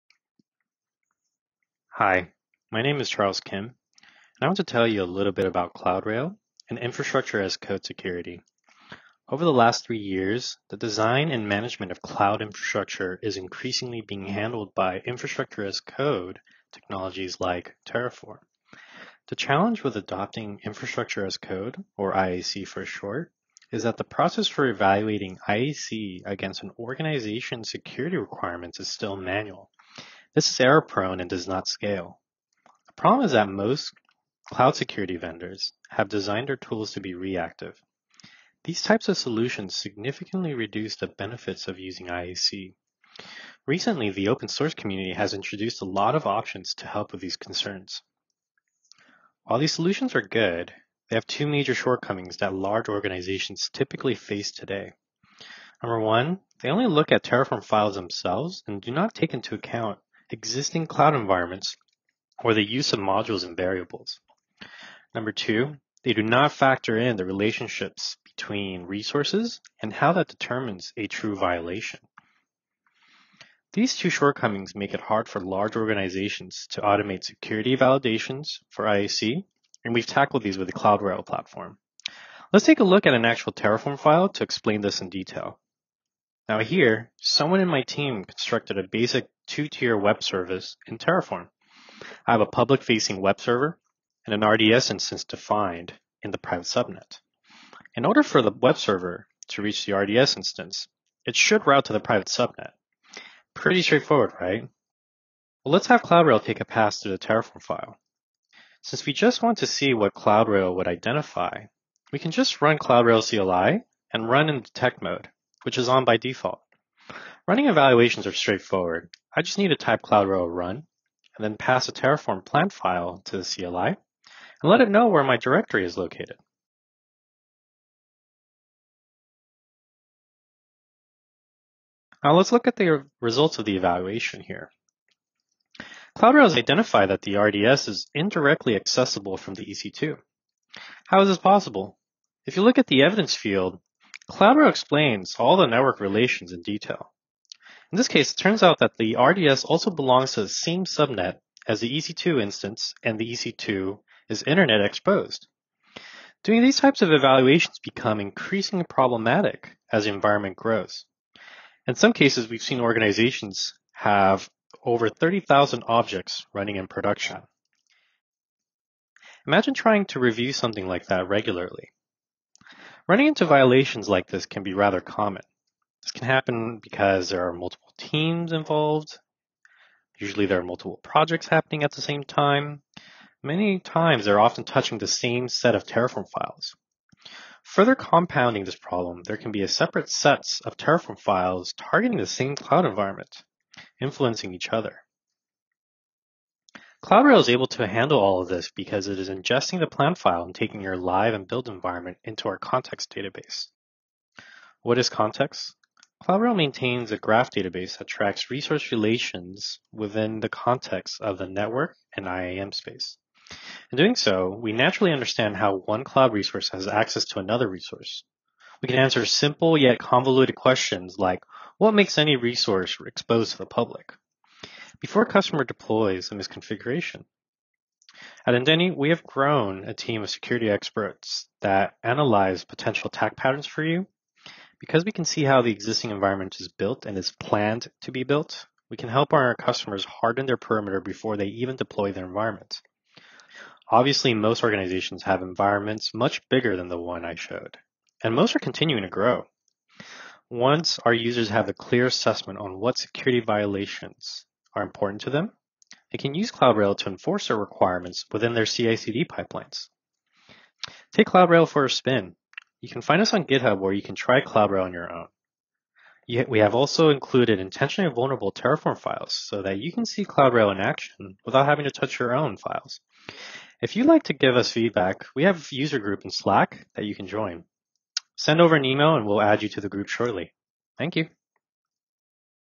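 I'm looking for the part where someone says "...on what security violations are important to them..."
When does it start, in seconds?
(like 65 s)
252 s.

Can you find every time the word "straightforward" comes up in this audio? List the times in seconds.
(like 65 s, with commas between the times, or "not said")
103 s, 118 s.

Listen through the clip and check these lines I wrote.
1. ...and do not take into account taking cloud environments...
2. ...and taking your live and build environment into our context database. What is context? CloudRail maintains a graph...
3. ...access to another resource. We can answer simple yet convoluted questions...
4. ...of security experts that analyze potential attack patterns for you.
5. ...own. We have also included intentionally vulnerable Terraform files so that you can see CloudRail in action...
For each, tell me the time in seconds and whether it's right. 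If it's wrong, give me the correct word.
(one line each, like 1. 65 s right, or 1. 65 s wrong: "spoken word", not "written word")
1. 58 s wrong: "existing", not "taking"
2. 200 s right
3. 216 s right
4. 230 s right
5. 265 s right.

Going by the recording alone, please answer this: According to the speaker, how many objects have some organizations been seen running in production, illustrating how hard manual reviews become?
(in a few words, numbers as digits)
30,000.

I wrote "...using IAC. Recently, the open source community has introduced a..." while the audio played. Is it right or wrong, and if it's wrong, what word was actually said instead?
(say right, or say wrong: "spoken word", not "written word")
right.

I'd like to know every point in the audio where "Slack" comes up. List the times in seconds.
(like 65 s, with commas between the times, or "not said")
276 s.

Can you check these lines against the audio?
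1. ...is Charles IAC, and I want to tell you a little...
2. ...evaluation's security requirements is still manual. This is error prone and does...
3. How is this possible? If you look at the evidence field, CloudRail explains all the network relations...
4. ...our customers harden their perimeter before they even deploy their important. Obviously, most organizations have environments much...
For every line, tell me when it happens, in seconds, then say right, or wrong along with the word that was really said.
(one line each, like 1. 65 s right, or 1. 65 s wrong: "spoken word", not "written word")
1. 2 s wrong: "Kim", not "IAC"
2. 26 s wrong: "organization", not "evaluation"
3. 141 s right
4. 239 s wrong: "environment", not "important".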